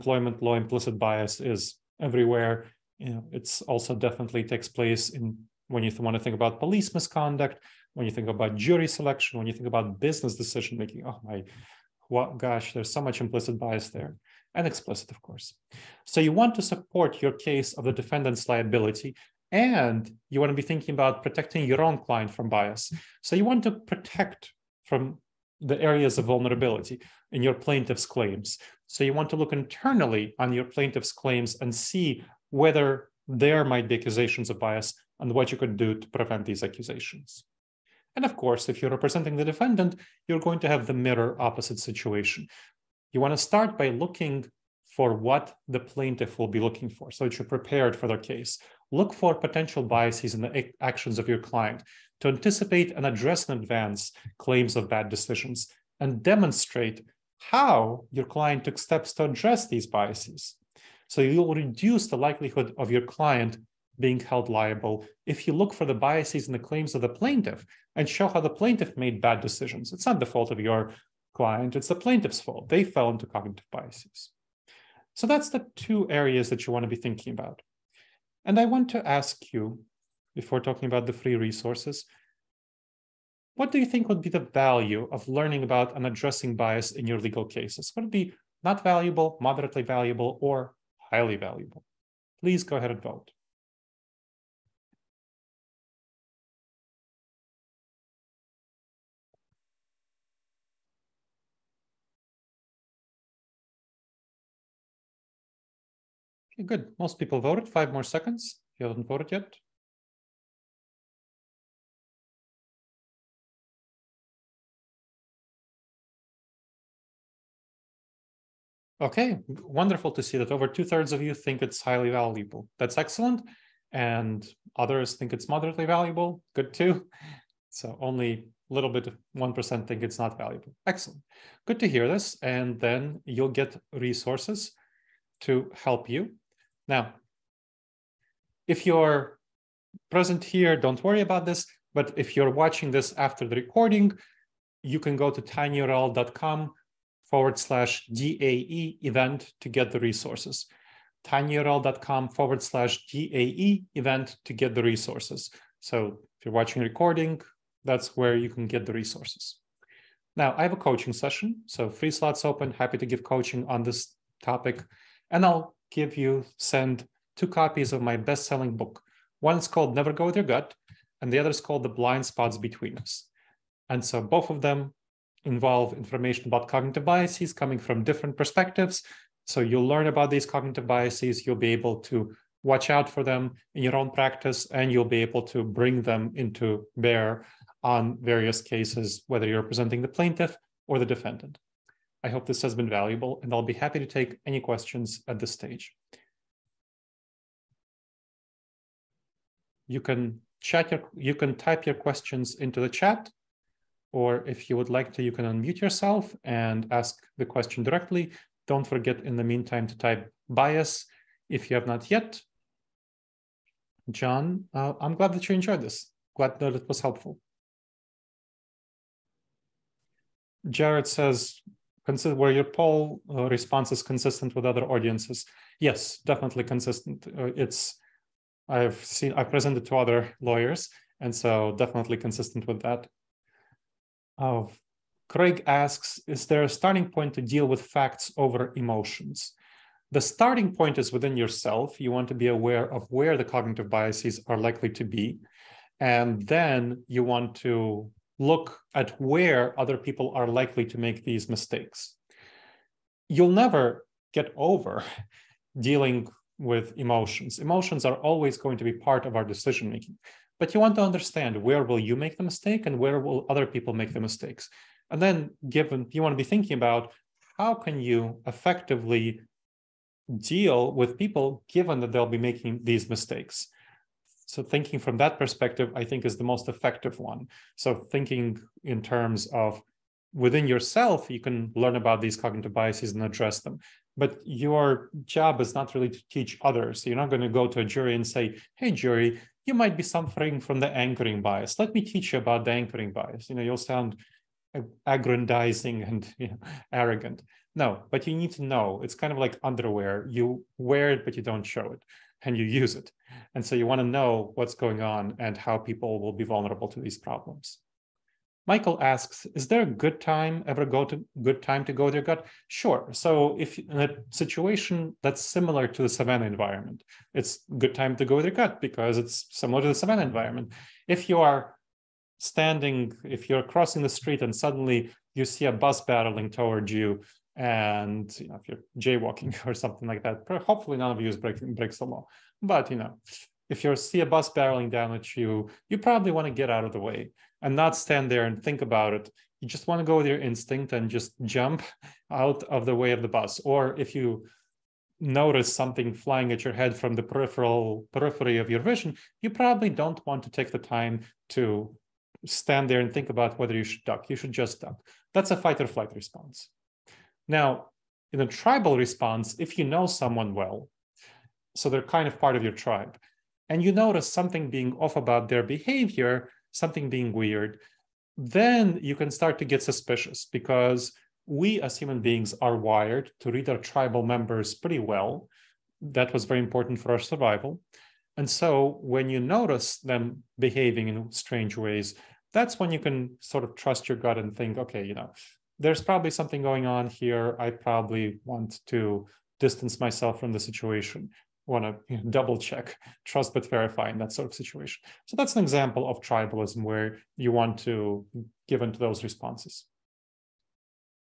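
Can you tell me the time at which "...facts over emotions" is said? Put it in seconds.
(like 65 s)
237 s.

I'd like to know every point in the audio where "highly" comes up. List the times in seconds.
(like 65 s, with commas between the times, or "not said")
91 s, 121 s.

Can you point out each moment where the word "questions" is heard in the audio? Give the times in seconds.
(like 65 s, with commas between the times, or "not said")
194 s, 201 s, 207 s.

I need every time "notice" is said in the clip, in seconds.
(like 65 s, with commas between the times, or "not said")
345 s, 363 s, 379 s.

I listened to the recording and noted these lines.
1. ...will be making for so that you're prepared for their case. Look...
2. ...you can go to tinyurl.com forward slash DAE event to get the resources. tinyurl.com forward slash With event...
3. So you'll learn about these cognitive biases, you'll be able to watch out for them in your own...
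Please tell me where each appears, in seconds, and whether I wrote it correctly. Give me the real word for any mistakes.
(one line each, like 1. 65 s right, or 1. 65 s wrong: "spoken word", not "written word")
1. 46 s wrong: "looking", not "making"
2. 144 s wrong: "DAE", not "With"
3. 179 s right.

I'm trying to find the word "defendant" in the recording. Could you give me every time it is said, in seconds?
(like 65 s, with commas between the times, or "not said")
17 s, 39 s, 191 s.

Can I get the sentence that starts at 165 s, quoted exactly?
And I'll give you, send two copies of my best selling book.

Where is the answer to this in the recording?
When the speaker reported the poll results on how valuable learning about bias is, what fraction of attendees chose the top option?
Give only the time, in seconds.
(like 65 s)
120 s.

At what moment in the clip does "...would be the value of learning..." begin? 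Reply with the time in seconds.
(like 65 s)
84 s.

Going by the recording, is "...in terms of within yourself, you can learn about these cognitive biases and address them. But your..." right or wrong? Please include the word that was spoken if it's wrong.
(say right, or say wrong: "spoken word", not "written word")
right.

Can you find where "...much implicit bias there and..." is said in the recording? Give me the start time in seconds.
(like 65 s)
13 s.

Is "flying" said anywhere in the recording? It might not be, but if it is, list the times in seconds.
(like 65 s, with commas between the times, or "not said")
346 s.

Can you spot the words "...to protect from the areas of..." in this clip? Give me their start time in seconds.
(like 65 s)
23 s.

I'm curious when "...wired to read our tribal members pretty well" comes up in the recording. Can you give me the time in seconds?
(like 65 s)
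372 s.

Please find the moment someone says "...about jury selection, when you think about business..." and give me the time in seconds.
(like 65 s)
8 s.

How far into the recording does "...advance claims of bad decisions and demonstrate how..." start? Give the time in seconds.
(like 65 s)
53 s.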